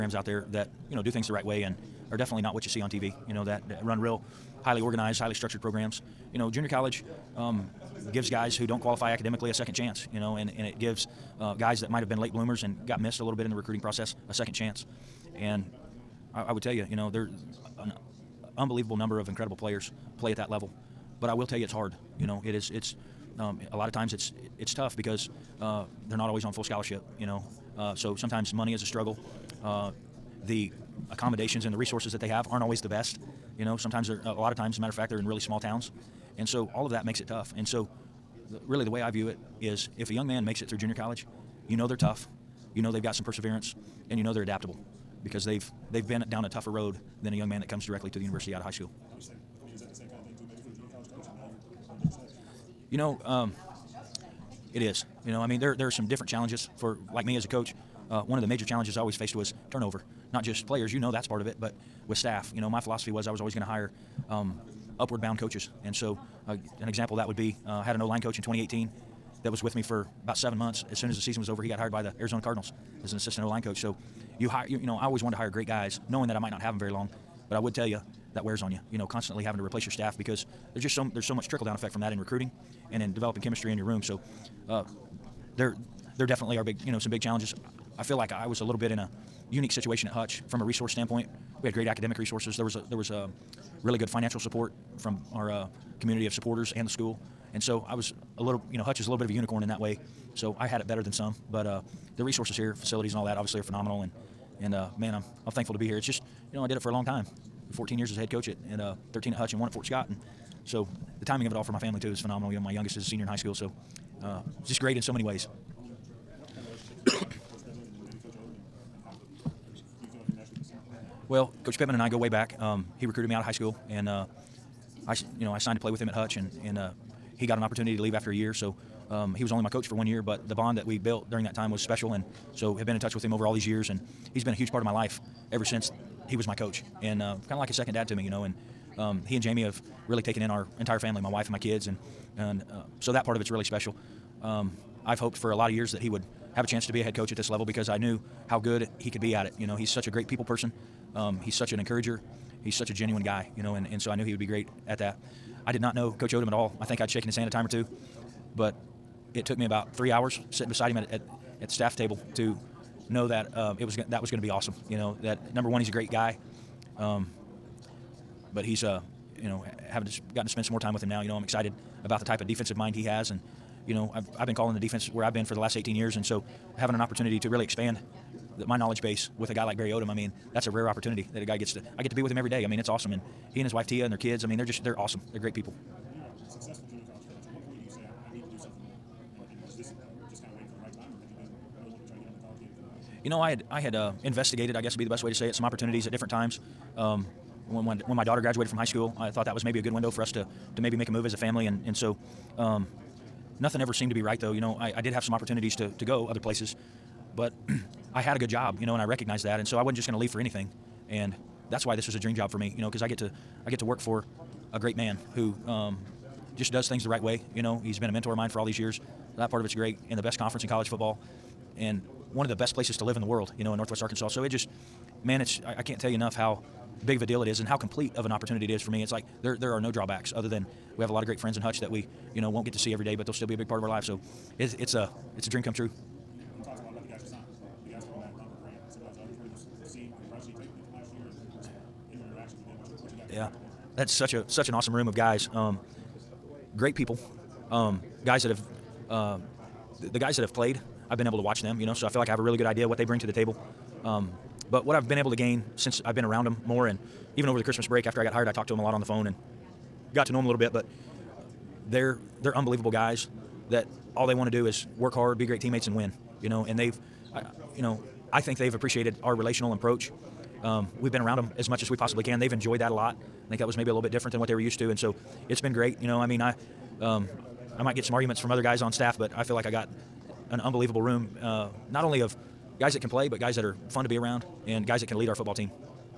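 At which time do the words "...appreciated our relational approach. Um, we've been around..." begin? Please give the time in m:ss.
4:28.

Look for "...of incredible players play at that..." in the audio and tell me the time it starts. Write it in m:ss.
0:19.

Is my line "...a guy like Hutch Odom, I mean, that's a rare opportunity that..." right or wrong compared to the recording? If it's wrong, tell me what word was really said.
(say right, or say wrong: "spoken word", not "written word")
wrong: "Barry", not "Hutch".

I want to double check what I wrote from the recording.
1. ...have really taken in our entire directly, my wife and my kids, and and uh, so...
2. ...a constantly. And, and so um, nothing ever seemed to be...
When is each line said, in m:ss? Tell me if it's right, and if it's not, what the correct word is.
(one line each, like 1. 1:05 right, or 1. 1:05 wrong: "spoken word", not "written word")
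1. 2:19 wrong: "family", not "directly"
2. 3:21 wrong: "family", not "constantly".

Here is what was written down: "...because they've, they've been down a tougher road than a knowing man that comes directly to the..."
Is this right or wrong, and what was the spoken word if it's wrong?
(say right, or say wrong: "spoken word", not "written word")
wrong: "young", not "knowing".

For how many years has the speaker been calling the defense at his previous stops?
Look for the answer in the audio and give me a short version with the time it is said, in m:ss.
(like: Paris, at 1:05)
18, at 2:55.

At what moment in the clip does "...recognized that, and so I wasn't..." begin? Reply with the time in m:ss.
3:29.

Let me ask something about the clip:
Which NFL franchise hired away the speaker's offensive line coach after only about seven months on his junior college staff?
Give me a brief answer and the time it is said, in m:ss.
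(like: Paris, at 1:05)
Arizona Cardinals, at 1:12.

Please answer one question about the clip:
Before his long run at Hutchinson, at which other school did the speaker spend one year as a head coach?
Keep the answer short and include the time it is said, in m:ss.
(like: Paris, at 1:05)
Fort Scott, at 1:49.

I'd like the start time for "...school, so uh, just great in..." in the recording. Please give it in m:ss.
1:53.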